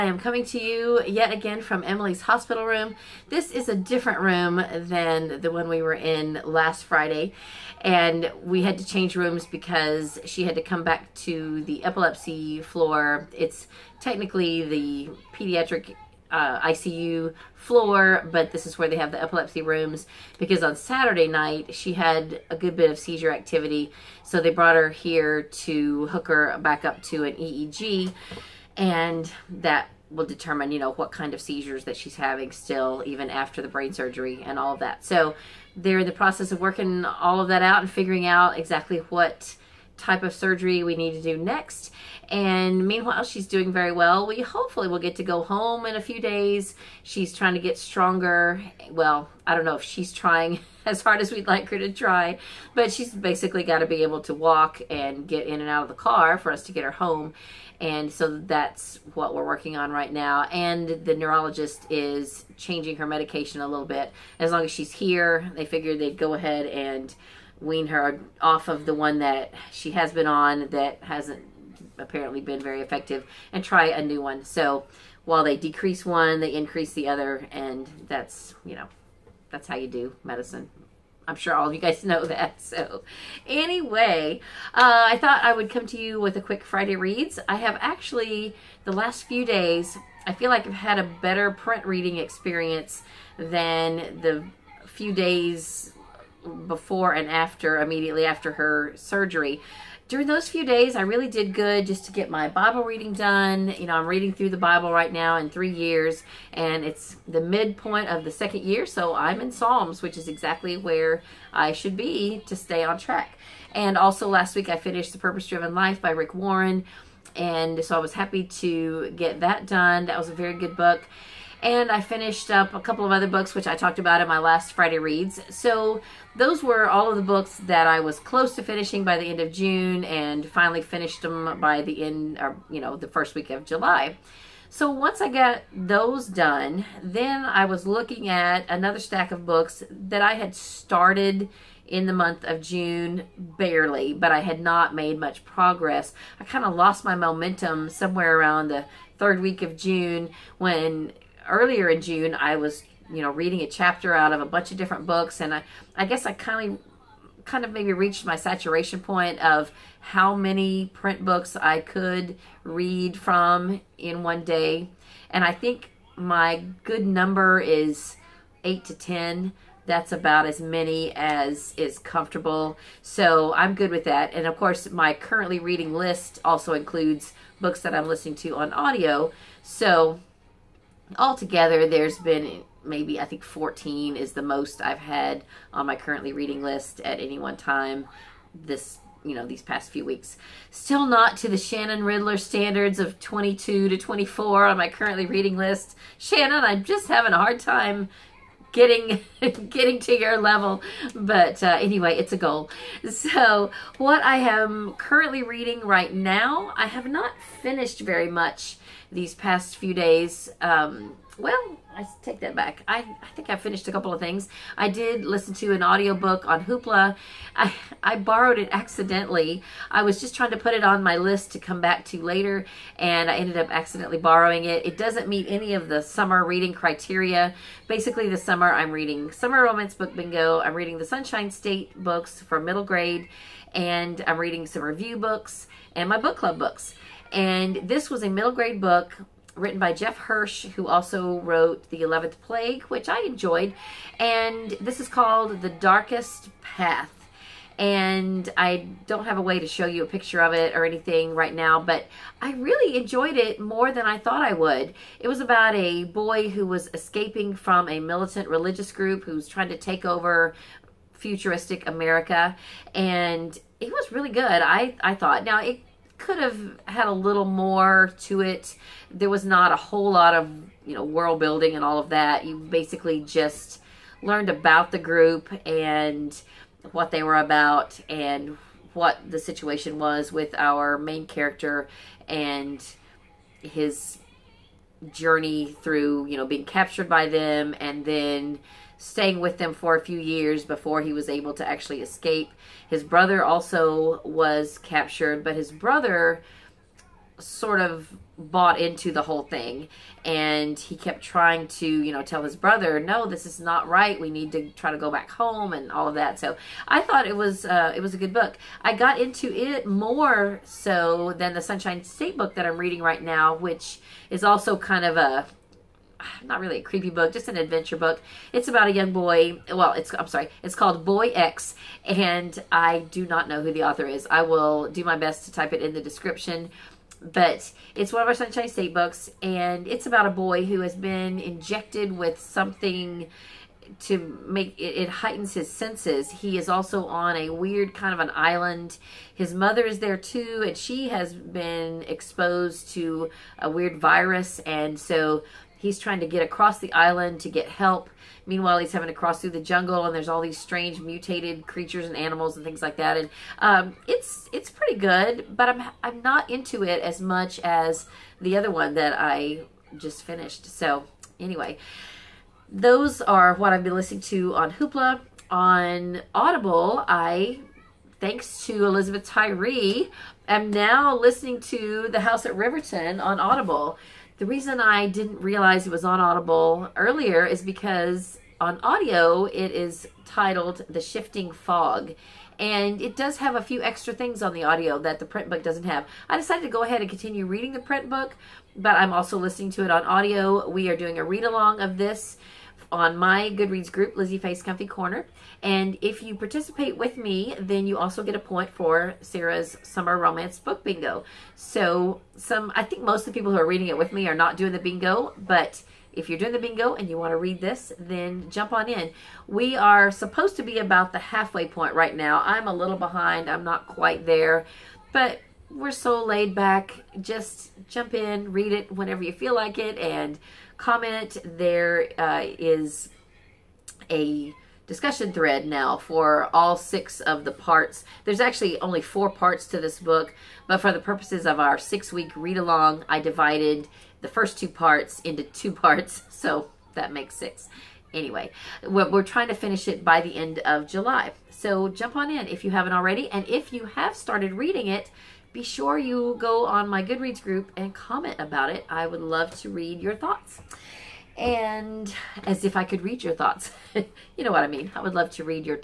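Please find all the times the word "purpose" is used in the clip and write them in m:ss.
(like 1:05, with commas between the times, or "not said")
1:55, 7:11.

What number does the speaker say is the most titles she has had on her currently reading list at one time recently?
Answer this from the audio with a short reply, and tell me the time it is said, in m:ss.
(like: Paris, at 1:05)
14, at 3:03.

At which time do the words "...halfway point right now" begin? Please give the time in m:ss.
6:51.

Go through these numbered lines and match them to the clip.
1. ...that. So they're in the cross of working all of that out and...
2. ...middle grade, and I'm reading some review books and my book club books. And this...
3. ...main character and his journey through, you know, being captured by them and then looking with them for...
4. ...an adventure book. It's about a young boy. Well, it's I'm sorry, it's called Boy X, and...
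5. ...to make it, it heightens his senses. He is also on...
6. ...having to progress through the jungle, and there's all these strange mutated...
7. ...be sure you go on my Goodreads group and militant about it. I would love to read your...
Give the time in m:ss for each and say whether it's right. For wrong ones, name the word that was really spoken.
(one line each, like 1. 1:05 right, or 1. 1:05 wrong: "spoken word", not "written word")
1. 0:34 wrong: "process", not "cross"
2. 3:52 right
3. 4:40 wrong: "staying", not "looking"
4. 5:17 right
5. 5:34 right
6. 5:48 wrong: "cross", not "progress"
7. 7:25 wrong: "comment", not "militant".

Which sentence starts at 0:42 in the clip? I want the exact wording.
And meanwhile, she's doing very well.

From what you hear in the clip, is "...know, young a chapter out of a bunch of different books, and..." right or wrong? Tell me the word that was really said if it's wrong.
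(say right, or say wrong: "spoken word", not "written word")
wrong: "reading", not "young".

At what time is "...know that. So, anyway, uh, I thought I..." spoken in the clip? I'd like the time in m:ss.
1:22.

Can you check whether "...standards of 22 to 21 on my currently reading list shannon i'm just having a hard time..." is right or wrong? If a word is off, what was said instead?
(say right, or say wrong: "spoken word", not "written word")
wrong: "24", not "21".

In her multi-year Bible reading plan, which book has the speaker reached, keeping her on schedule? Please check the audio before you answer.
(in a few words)
Psalms.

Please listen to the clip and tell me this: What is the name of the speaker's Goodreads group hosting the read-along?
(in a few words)
Lizzie Faye's Comfy Corner.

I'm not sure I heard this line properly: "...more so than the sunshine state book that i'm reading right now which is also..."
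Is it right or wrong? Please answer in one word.
right.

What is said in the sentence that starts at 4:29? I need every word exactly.
There was not a whole lot of, you know, world building and all of that.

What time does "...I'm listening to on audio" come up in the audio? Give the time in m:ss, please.
2:57.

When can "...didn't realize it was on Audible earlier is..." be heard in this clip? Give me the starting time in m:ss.
6:15.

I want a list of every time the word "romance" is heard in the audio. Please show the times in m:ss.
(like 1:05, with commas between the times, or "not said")
3:49, 6:40.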